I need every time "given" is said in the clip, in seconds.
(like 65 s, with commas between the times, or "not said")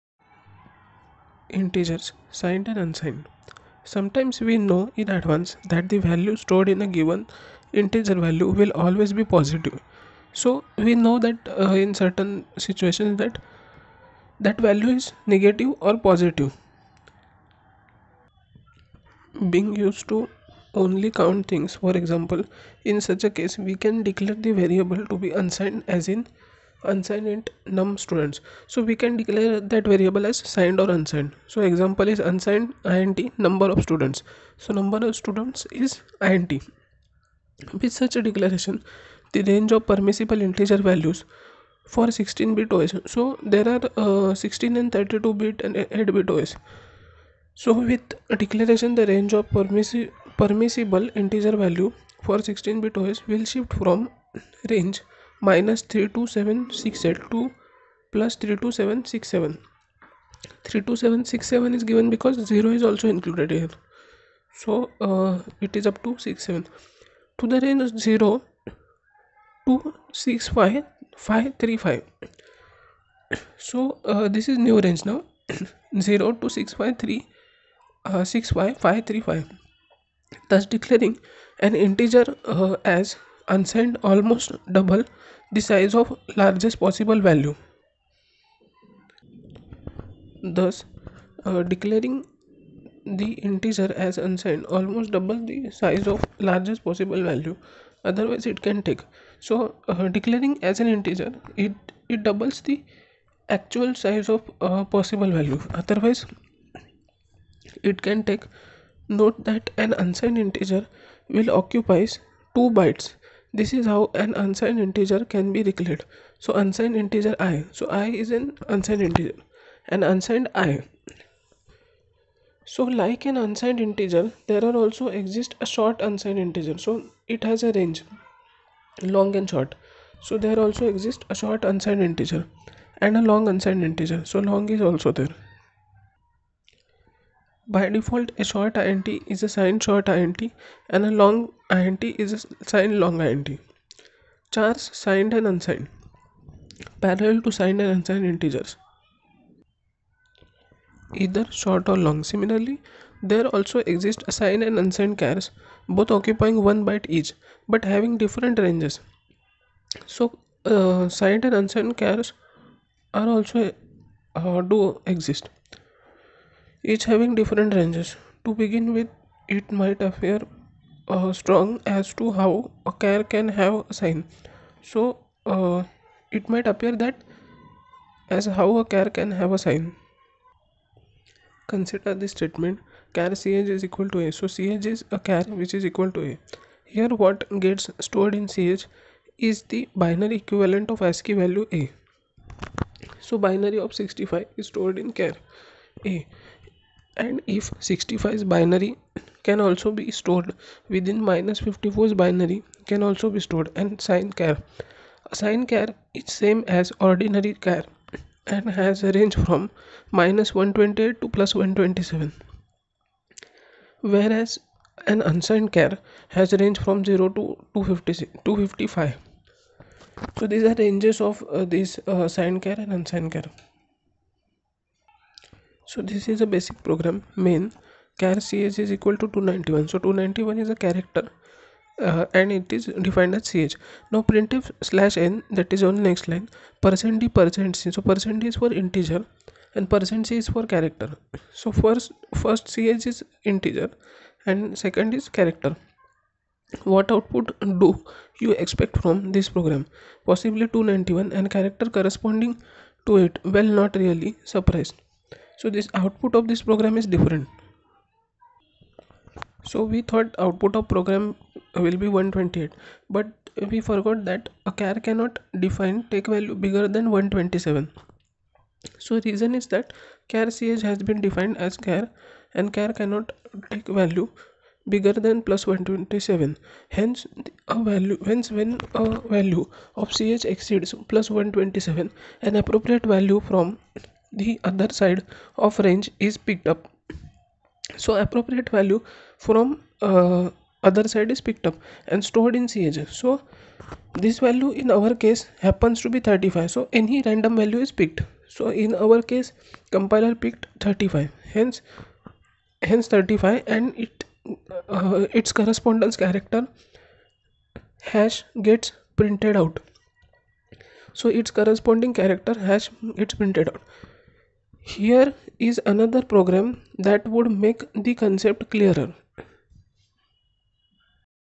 6 s, 61 s.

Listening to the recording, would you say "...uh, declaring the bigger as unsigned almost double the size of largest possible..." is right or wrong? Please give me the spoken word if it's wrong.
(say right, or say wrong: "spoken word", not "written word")
wrong: "integer", not "bigger".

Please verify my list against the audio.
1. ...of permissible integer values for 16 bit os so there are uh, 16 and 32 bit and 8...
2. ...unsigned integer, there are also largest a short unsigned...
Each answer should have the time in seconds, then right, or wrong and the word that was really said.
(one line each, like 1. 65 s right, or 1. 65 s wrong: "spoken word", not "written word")
1. 39 s right
2. 123 s wrong: "exist", not "largest".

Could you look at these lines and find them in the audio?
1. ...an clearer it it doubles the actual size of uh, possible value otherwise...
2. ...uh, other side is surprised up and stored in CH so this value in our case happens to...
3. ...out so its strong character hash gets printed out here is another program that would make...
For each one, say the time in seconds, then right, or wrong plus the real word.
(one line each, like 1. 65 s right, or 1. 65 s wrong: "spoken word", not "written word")
1. 100 s wrong: "integer", not "clearer"
2. 290 s wrong: "picked", not "surprised"
3. 309 s wrong: "corresponding", not "strong".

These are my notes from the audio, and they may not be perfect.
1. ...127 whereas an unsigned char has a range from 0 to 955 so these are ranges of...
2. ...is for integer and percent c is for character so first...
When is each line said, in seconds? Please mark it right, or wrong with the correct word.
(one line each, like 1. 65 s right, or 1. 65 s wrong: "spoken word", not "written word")
1. 211 s wrong: "255", not "955"
2. 238 s right.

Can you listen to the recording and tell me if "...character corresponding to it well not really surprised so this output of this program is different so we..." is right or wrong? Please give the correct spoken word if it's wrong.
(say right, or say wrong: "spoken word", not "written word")
right.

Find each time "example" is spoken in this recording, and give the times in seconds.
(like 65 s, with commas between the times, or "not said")
21 s, 31 s.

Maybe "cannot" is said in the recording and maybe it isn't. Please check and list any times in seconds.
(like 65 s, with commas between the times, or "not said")
265 s, 273 s.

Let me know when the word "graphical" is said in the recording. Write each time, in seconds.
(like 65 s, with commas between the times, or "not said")
not said.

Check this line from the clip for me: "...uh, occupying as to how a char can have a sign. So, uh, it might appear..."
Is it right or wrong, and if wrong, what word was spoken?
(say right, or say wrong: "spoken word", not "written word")
wrong: "strong", not "occupying".